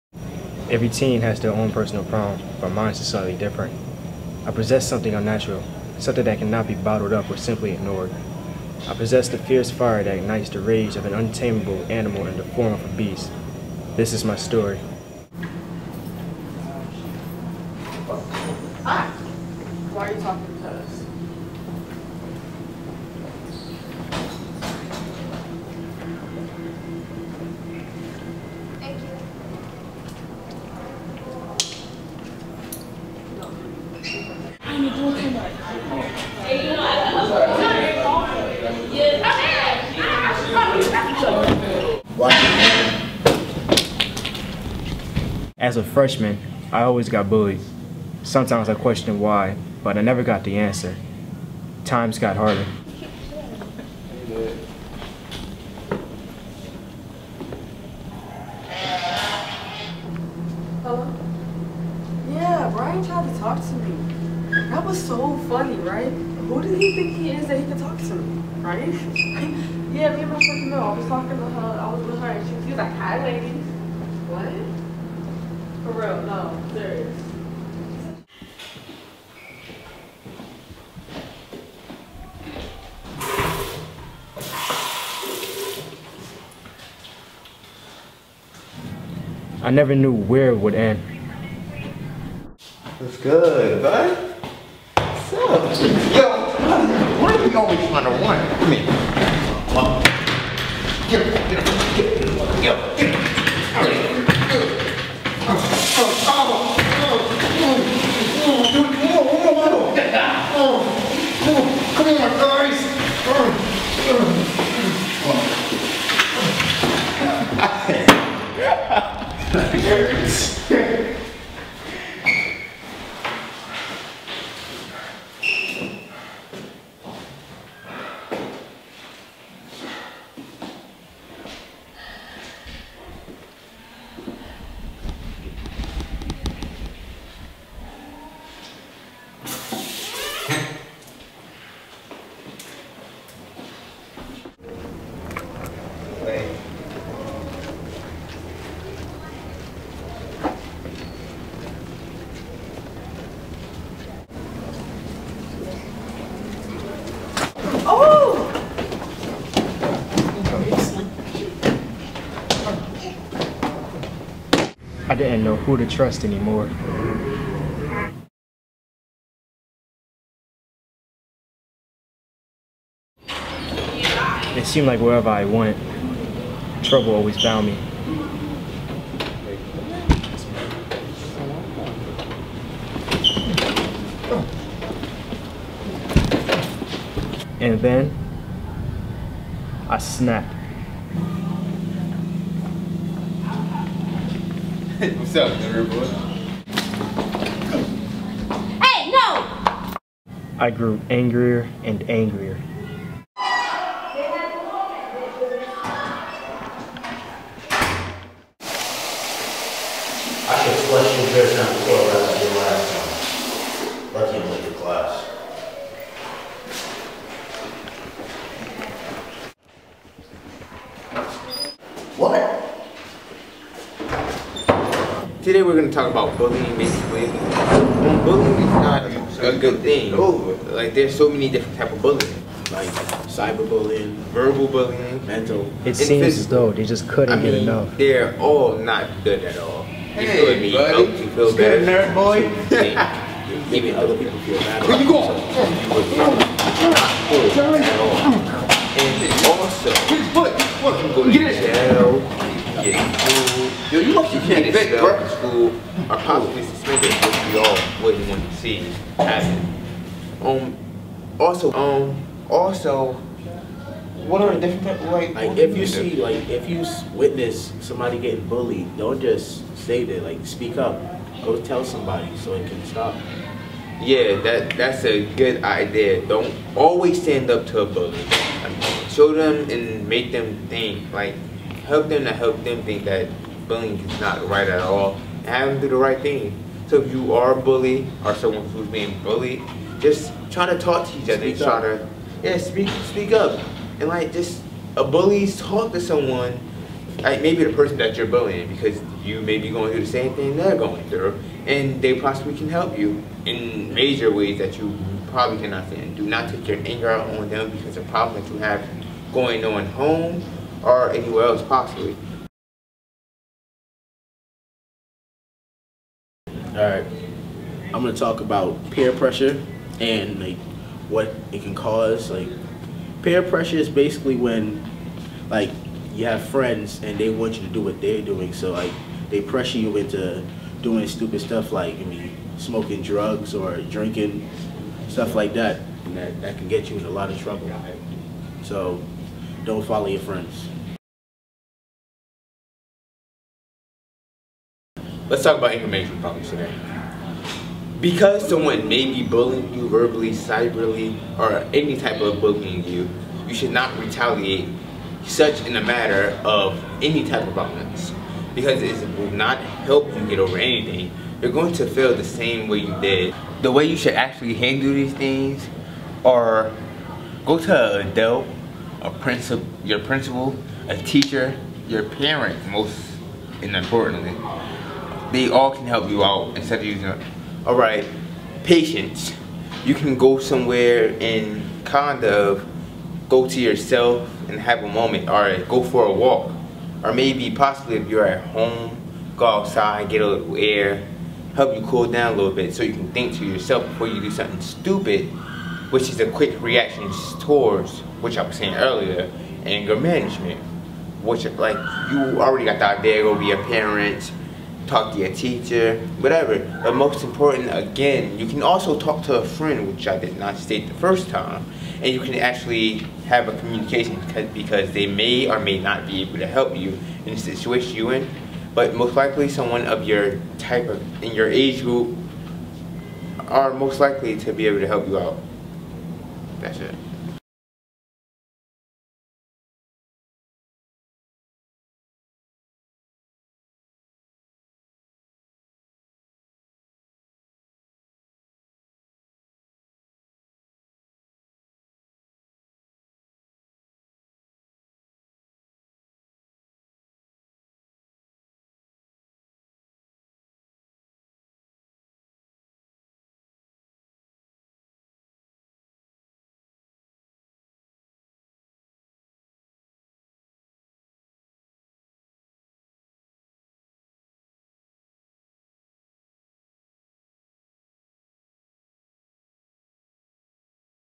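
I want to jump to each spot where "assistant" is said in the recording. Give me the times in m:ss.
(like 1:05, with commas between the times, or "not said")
not said.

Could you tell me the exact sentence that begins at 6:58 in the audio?
But most likely, someone of your type of in your age group are most likely to be able to help you out.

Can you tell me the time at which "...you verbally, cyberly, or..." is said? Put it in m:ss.
5:49.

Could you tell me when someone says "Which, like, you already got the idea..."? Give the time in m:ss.
6:41.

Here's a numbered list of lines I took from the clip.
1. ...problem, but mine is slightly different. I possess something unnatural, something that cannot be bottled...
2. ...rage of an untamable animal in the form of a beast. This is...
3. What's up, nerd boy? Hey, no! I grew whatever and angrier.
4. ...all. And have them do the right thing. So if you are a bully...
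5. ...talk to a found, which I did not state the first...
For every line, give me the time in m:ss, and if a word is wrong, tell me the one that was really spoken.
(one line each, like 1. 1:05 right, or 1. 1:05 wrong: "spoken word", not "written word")
1. 0:02 right
2. 0:10 right
3. 3:15 wrong: "angrier", not "whatever"
4. 4:44 right
5. 6:48 wrong: "friend", not "found".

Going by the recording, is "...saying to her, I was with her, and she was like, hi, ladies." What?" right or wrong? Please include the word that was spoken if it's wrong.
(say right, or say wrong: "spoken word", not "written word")
wrong: "talking", not "saying".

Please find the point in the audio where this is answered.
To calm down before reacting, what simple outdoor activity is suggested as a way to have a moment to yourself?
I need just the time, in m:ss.
6:25.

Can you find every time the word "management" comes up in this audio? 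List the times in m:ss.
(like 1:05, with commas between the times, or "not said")
5:45, 6:39.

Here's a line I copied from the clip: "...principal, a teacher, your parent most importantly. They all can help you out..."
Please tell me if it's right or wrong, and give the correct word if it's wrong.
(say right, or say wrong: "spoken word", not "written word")
right.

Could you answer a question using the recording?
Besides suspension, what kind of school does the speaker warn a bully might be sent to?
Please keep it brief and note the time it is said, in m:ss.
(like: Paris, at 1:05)
prep school, at 4:15.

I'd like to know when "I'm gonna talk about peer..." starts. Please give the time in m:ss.
5:17.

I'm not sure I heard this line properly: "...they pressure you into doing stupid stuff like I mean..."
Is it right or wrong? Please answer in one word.
right.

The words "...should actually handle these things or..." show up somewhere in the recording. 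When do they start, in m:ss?
6:03.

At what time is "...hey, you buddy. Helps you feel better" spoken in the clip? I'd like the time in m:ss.
4:00.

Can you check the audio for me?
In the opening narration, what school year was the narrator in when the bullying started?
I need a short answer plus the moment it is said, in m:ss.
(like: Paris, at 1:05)
freshman, at 0:45.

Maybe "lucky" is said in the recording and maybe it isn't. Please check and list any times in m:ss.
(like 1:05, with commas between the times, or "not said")
3:34, 4:14.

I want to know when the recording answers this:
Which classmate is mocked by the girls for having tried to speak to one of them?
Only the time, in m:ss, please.
1:02.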